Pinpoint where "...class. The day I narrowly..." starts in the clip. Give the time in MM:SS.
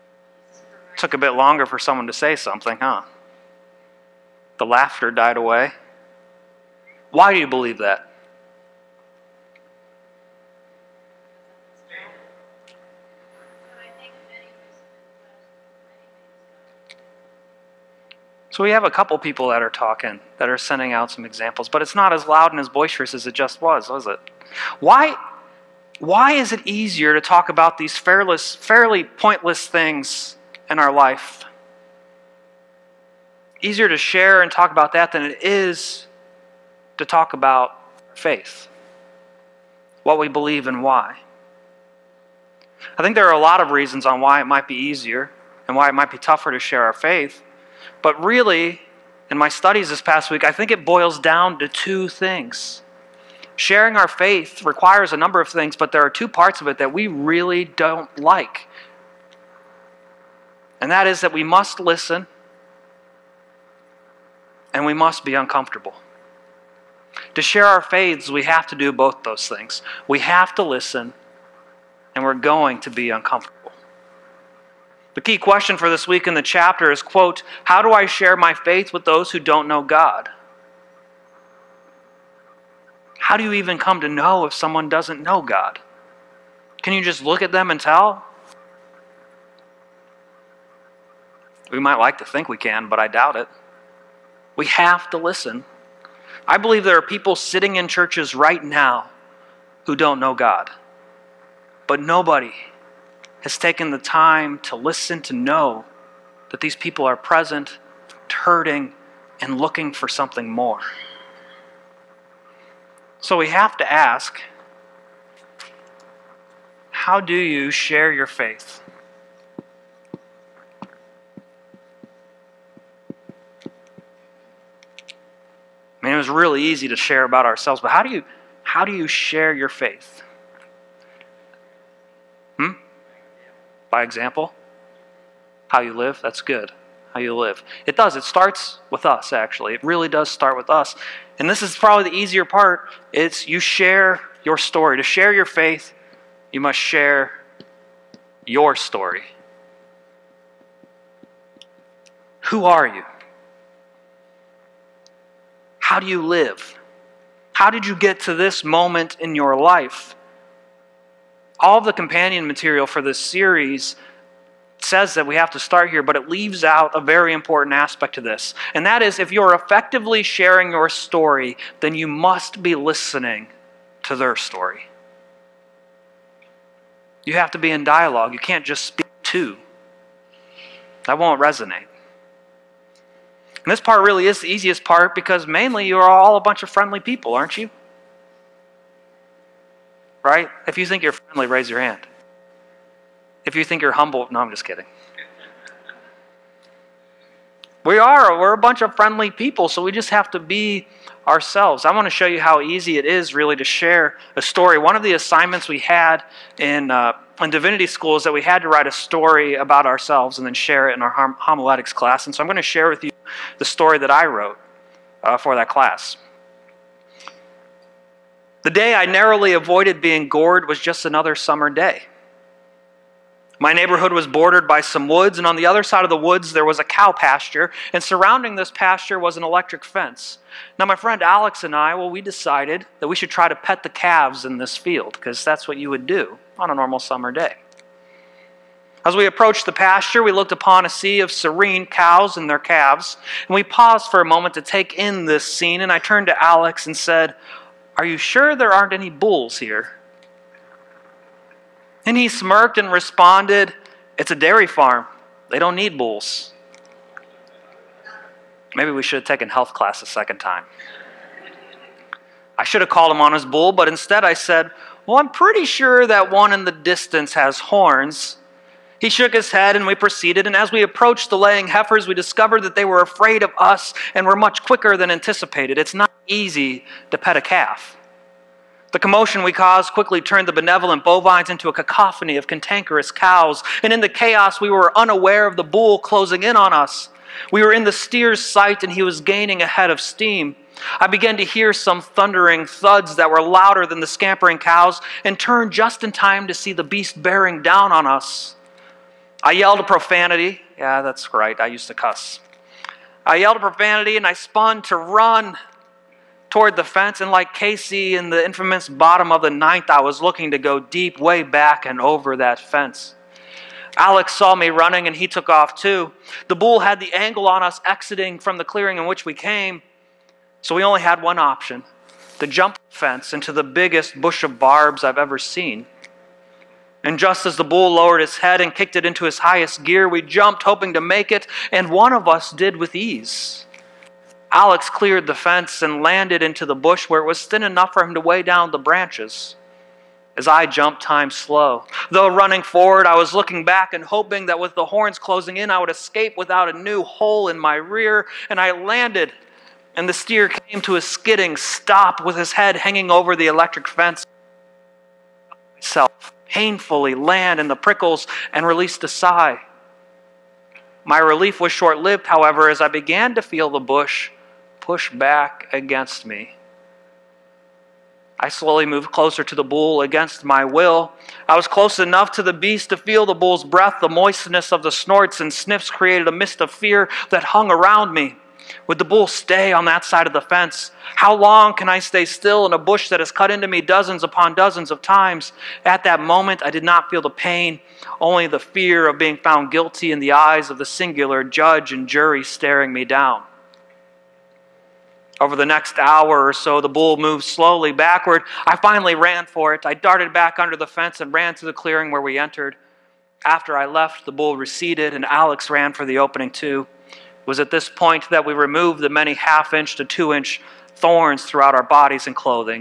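03:35.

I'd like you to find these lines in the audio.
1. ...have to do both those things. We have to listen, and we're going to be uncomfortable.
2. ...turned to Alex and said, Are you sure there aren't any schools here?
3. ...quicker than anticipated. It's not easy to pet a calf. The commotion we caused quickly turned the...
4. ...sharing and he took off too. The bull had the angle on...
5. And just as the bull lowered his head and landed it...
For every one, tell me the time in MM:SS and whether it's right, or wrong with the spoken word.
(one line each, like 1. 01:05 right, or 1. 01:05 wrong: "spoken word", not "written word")
1. 01:08 right
2. 04:05 wrong: "bulls", not "schools"
3. 04:34 right
4. 05:14 wrong: "running", not "sharing"
5. 05:27 wrong: "kicked", not "landed".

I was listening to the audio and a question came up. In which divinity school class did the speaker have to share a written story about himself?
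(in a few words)
Homiletics.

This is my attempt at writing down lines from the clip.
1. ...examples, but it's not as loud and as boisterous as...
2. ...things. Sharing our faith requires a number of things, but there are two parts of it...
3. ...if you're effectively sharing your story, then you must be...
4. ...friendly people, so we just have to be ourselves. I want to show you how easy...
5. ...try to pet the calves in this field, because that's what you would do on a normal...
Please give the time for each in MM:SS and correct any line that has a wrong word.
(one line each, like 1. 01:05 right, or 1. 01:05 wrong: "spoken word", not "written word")
1. 00:21 right
2. 00:52 right
3. 02:49 right
4. 03:18 right
5. 03:53 right.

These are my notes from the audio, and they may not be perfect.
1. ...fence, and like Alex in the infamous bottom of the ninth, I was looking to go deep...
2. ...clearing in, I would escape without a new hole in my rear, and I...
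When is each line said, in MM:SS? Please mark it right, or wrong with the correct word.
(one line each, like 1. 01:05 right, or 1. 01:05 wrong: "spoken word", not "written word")
1. 05:06 wrong: "Casey", not "Alex"
2. 05:45 wrong: "closing", not "clearing".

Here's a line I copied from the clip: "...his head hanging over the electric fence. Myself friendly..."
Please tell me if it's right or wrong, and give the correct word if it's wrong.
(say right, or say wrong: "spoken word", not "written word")
wrong: "painfully", not "friendly".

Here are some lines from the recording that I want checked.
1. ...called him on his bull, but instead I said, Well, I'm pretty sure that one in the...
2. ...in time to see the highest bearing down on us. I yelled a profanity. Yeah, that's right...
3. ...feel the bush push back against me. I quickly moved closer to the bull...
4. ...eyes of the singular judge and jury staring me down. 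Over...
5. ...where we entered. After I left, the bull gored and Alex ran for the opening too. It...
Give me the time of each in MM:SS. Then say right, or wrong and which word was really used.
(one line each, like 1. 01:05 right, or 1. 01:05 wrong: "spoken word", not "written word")
1. 04:22 right
2. 04:56 wrong: "beast", not "highest"
3. 06:03 wrong: "slowly", not "quickly"
4. 06:30 right
5. 06:42 wrong: "receded", not "gored".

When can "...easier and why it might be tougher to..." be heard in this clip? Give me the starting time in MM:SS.
00:44.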